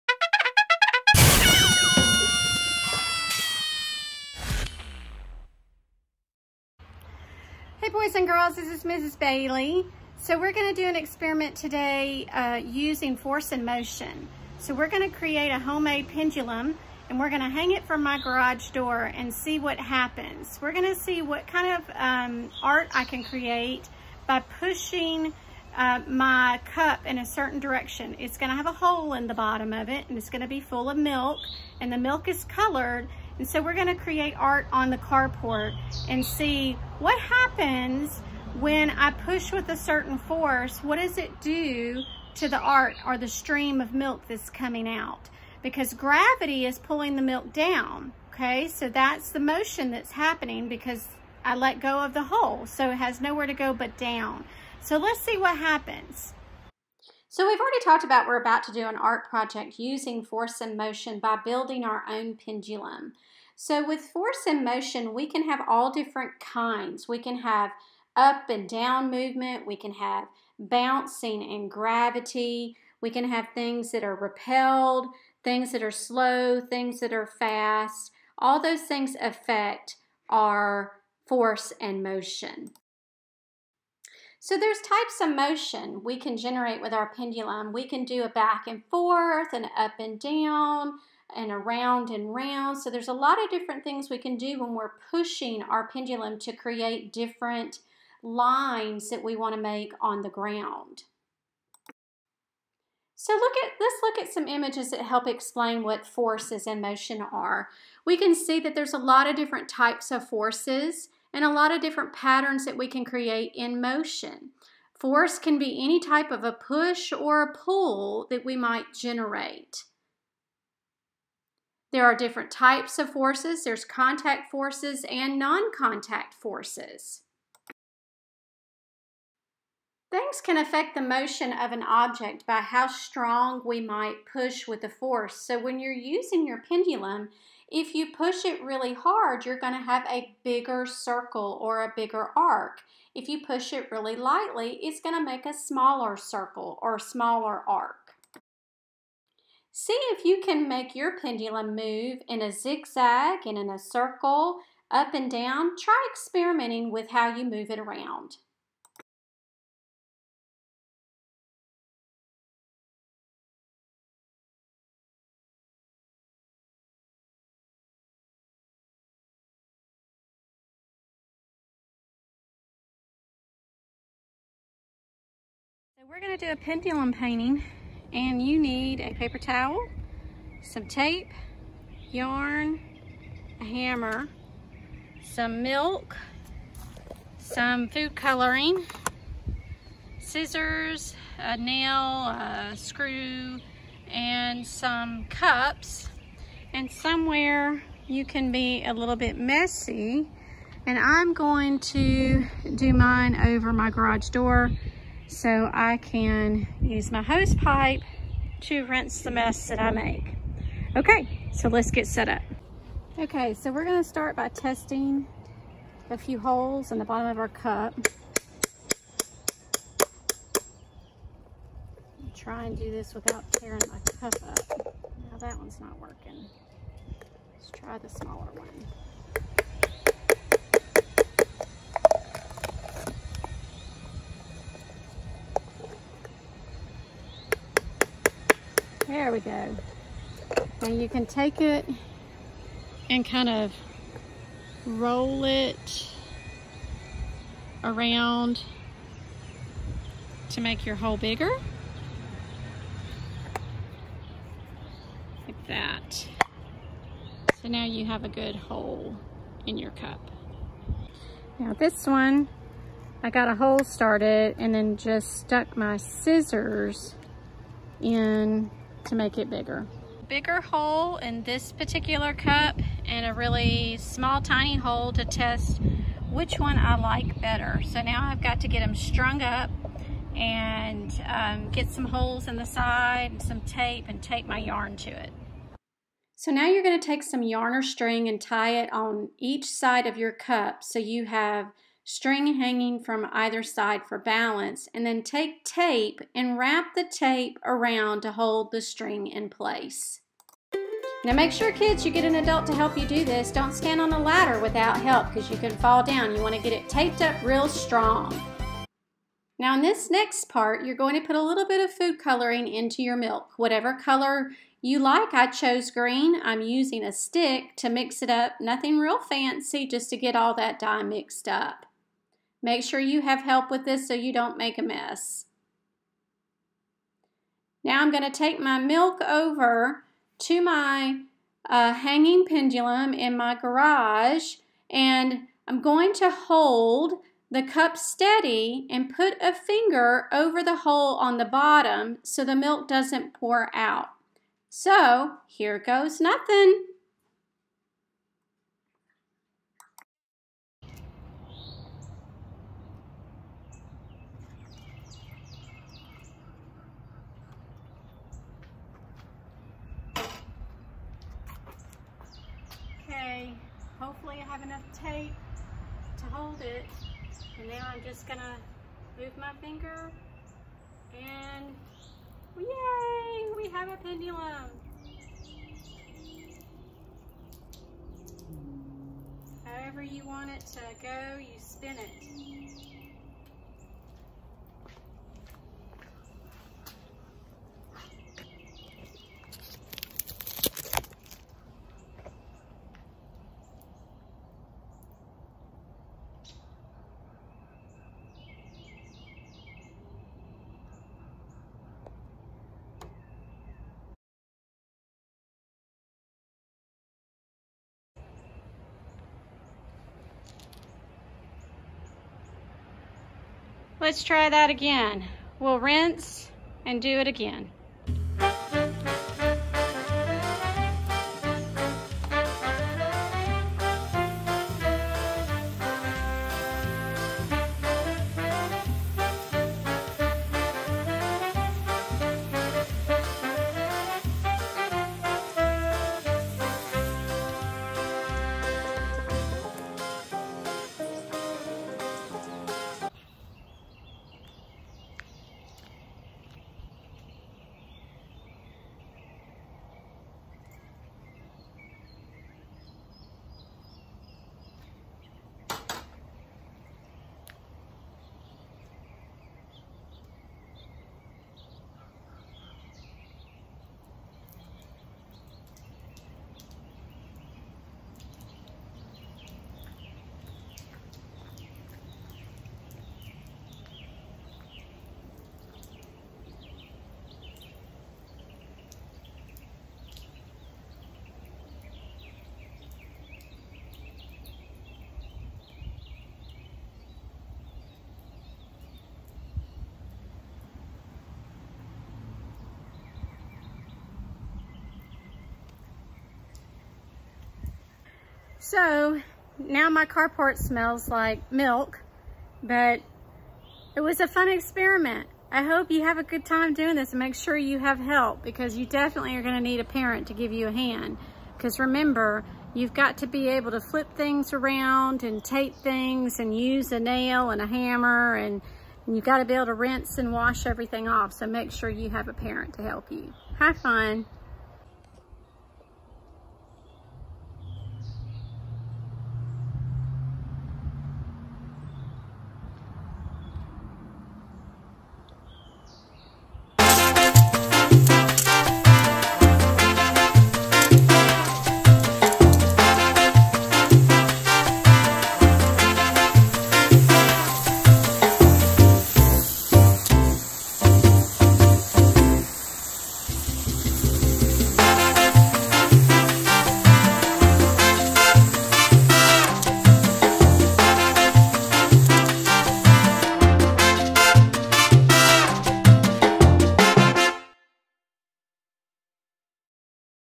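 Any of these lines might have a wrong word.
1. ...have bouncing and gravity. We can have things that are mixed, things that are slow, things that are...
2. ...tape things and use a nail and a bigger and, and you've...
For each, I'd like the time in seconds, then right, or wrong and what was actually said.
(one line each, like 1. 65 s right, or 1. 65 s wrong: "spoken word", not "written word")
1. 69 s wrong: "repelled", not "mixed"
2. 515 s wrong: "hammer", not "bigger".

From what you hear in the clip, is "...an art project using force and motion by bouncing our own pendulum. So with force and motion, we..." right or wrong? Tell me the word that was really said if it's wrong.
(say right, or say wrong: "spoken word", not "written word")
wrong: "building", not "bouncing".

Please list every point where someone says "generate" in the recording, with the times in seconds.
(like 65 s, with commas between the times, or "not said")
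86 s, 118 s.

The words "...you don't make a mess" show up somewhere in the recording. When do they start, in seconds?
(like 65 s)
324 s.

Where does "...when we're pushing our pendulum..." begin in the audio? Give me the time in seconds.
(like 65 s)
94 s.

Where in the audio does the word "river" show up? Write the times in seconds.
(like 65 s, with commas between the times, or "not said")
not said.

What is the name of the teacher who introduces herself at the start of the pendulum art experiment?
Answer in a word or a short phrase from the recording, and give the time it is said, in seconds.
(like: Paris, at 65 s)
Mrs. Bailey, at 8 s.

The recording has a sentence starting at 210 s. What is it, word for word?
Okay, so let's get set up.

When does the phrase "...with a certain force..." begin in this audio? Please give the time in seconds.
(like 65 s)
39 s.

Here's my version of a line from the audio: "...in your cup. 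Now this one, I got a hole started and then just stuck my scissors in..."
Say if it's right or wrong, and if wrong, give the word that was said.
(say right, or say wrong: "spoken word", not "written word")
right.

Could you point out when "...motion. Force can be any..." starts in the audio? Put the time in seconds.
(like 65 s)
113 s.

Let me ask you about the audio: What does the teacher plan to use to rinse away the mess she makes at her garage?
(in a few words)
Hose pipe.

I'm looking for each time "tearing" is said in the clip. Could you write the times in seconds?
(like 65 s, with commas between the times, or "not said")
223 s.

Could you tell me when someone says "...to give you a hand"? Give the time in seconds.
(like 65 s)
510 s.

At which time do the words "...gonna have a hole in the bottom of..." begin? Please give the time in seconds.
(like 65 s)
28 s.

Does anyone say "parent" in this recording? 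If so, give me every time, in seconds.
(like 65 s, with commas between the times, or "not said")
509 s, 522 s.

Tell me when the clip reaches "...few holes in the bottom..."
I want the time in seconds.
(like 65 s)
216 s.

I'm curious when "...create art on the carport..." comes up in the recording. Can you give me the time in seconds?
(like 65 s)
33 s.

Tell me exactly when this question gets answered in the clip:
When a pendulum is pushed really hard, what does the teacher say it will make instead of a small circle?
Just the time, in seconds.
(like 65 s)
140 s.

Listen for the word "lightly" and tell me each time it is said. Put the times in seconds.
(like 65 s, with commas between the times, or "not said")
144 s.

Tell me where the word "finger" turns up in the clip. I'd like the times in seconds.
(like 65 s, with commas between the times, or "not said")
339 s, 369 s.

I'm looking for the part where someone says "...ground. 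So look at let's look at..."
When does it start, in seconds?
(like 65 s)
100 s.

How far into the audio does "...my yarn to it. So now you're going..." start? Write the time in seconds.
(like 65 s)
284 s.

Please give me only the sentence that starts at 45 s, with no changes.
Because gravity is pulling the milk down, okay?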